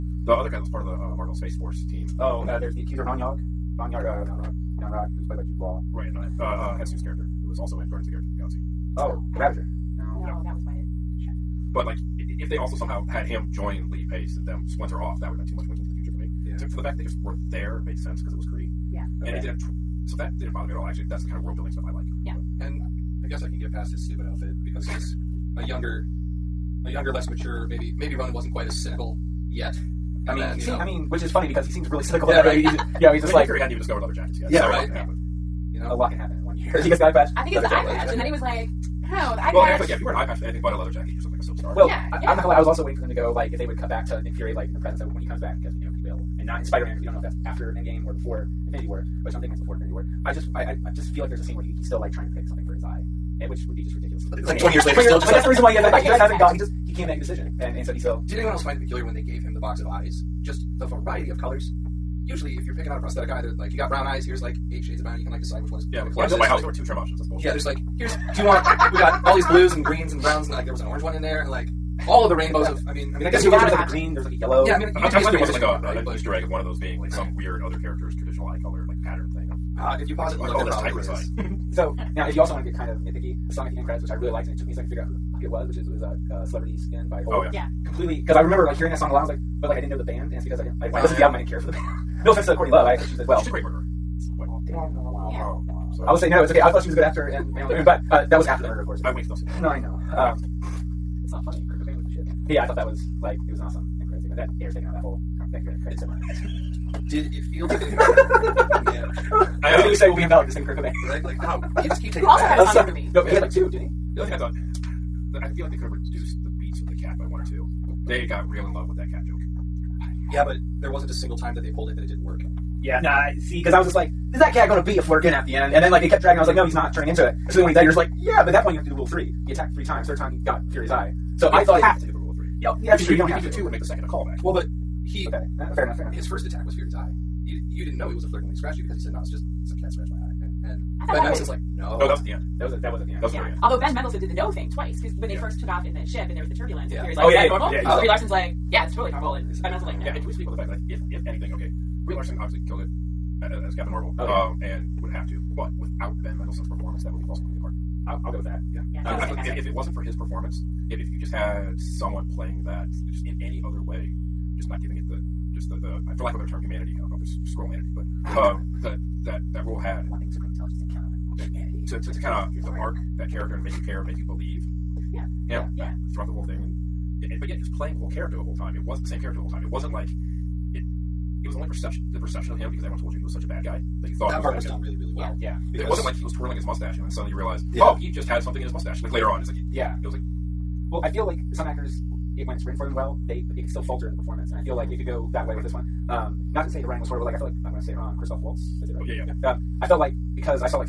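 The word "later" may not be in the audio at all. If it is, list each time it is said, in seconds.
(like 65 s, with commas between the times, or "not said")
54 s, 189 s.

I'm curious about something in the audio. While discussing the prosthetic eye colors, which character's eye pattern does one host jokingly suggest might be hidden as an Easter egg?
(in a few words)
Tigra.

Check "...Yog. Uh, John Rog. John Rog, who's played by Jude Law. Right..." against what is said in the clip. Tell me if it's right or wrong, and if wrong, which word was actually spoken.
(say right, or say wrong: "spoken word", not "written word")
right.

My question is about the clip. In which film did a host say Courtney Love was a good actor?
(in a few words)
Man on the Moon.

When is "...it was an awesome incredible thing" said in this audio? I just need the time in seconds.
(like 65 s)
103 s.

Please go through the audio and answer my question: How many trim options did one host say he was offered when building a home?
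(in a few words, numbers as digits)
2.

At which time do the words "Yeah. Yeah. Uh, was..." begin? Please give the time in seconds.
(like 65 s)
158 s.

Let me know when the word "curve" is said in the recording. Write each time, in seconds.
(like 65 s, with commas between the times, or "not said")
not said.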